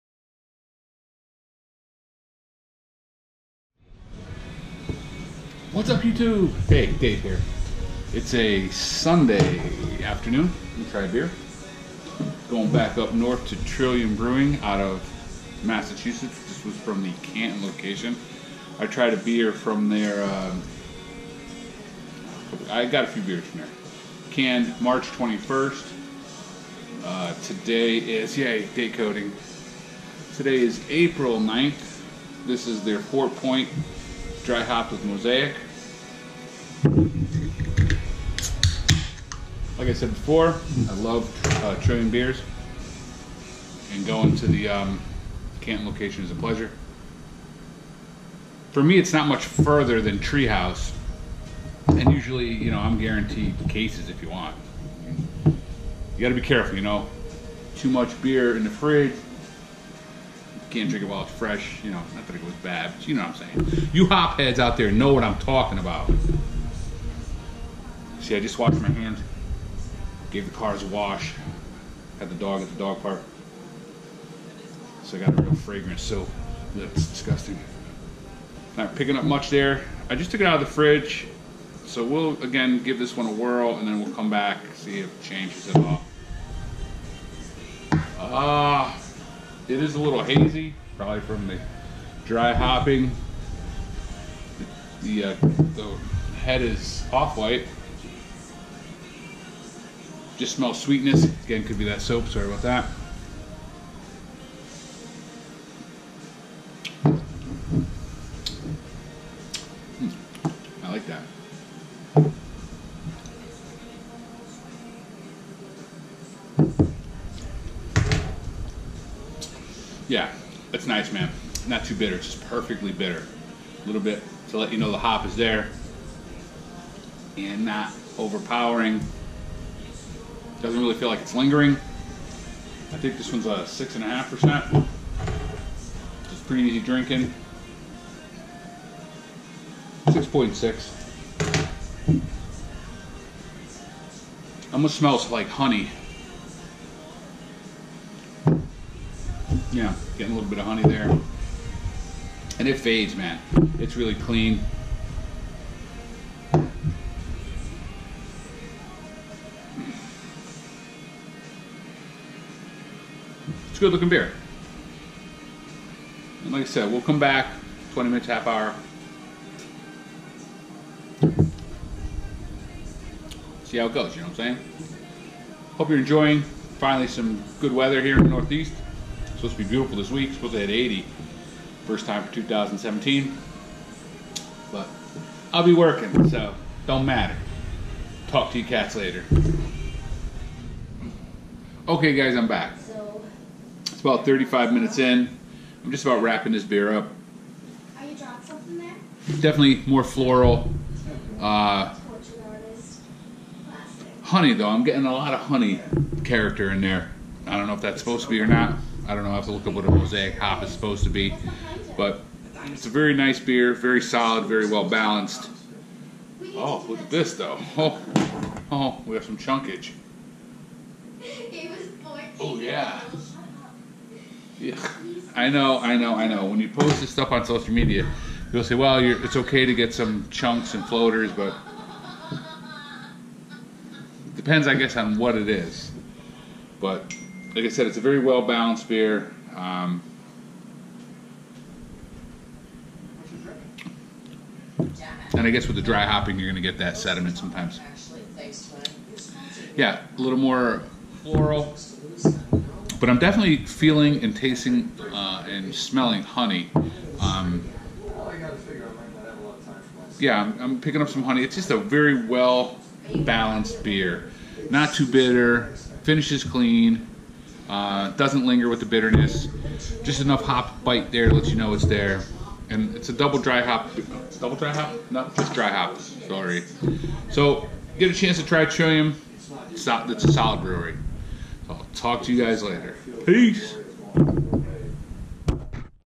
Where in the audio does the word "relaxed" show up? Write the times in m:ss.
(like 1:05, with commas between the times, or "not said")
not said.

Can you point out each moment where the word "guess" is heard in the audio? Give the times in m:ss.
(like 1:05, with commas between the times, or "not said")
3:54, 4:05.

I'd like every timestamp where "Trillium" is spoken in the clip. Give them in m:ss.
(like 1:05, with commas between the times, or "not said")
0:13, 4:38.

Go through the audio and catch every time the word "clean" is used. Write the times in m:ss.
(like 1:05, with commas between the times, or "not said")
2:34, 4:26.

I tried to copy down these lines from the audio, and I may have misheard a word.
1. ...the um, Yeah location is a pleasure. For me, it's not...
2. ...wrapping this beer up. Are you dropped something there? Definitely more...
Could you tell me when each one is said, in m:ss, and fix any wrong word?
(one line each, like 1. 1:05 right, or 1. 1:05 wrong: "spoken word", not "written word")
1. 0:44 wrong: "Canton", not "Yeah"
2. 3:16 right.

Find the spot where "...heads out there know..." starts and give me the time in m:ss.
1:04.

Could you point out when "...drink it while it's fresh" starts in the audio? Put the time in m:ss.
1:00.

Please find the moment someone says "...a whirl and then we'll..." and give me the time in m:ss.
1:23.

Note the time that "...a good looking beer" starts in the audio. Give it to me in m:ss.
2:43.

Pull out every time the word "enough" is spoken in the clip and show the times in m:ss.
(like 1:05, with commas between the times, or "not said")
4:30.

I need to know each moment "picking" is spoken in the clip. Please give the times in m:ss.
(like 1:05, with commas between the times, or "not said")
1:18, 4:20.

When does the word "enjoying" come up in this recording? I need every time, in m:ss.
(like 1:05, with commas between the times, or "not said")
2:55.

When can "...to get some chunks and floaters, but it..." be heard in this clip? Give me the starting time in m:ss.
3:49.